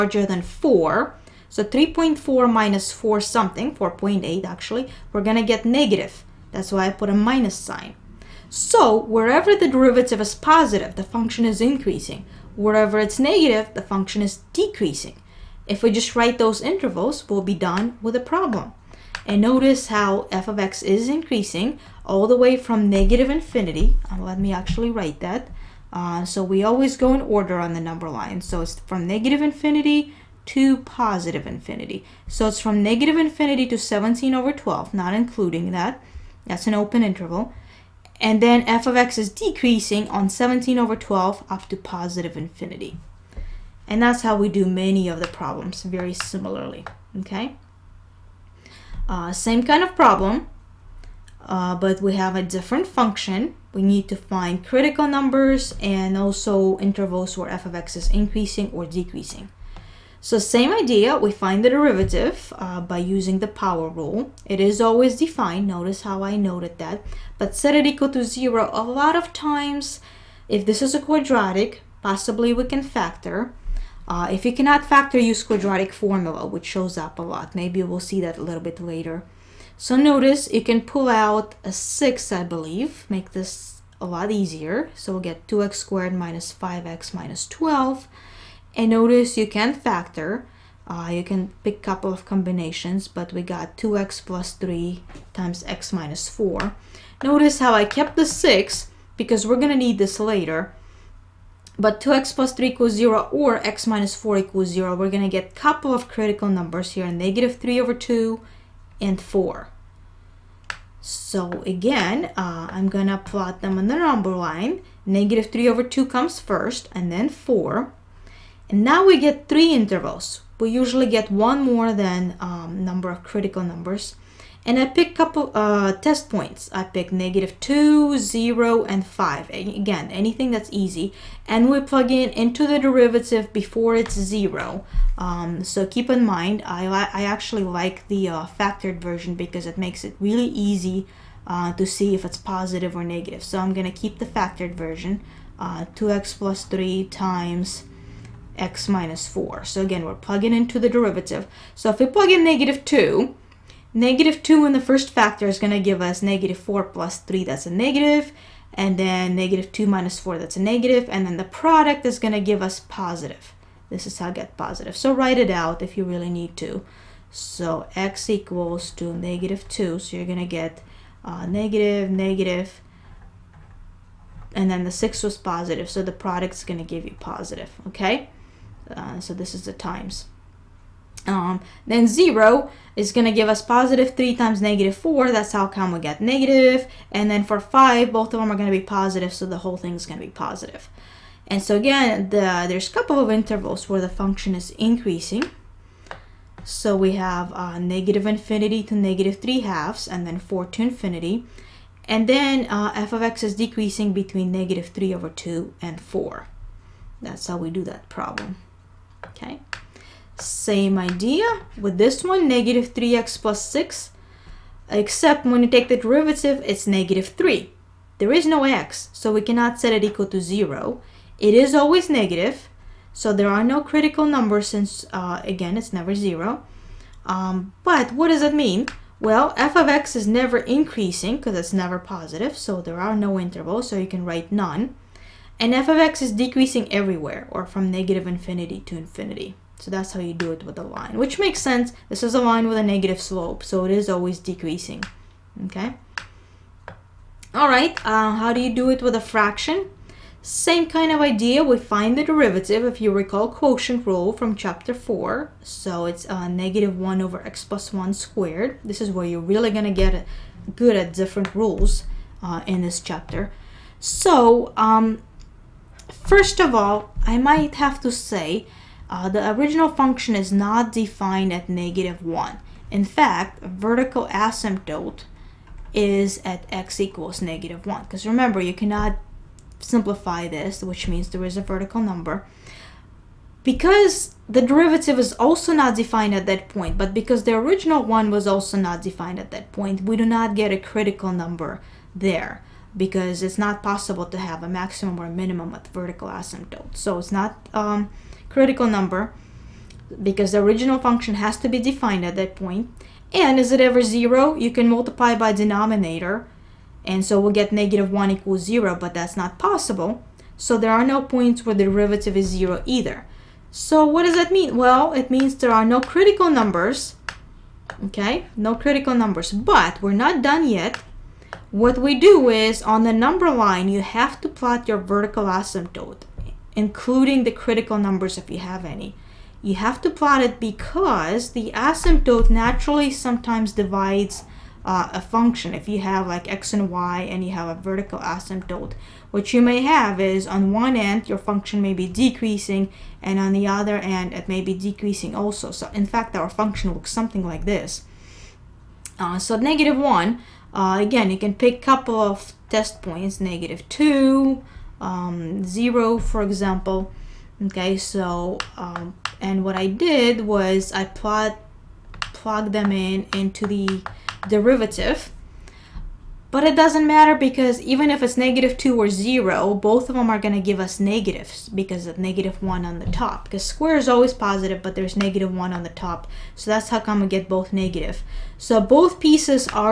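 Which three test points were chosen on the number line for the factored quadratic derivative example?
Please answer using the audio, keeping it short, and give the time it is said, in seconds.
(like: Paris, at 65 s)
-2, 0, and 5, at 127 s.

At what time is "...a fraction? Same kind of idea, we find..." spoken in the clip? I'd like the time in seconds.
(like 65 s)
249 s.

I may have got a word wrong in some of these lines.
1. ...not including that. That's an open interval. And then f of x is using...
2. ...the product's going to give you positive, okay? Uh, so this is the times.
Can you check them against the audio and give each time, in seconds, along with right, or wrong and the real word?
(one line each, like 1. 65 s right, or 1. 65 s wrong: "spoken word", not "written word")
1. 34 s wrong: "decreasing", not "using"
2. 176 s right.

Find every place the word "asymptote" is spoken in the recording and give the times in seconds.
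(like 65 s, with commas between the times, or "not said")
274 s, 296 s, 325 s, 331 s, 338 s.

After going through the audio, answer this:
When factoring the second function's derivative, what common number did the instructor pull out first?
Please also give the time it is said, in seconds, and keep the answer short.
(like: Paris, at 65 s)
6, at 81 s.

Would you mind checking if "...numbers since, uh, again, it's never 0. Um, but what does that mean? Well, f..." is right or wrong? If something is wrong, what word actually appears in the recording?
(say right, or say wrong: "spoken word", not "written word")
right.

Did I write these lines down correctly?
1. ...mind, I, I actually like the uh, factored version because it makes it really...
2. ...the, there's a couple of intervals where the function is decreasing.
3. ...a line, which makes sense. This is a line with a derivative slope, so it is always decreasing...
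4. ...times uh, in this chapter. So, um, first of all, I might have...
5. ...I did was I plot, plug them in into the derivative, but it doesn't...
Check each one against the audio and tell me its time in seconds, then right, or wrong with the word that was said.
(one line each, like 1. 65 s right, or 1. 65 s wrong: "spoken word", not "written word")
1. 136 s right
2. 192 s wrong: "increasing", not "decreasing"
3. 240 s wrong: "negative", not "derivative"
4. 261 s wrong: "rules", not "times"
5. 359 s right.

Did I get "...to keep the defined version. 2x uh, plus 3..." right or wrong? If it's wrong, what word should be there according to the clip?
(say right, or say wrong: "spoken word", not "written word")
wrong: "factored", not "defined".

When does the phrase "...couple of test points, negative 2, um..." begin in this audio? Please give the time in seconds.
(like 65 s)
351 s.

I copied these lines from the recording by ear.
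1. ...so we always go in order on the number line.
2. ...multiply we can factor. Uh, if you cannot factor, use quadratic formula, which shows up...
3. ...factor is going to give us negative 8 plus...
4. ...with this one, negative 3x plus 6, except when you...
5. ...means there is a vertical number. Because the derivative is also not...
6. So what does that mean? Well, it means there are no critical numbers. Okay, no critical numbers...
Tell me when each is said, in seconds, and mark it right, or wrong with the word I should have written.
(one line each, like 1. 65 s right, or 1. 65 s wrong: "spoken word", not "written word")
1. 26 s right
2. 72 s wrong: "possibly", not "multiply"
3. 155 s wrong: "4", not "8"
4. 211 s right
5. 281 s right
6. 313 s right.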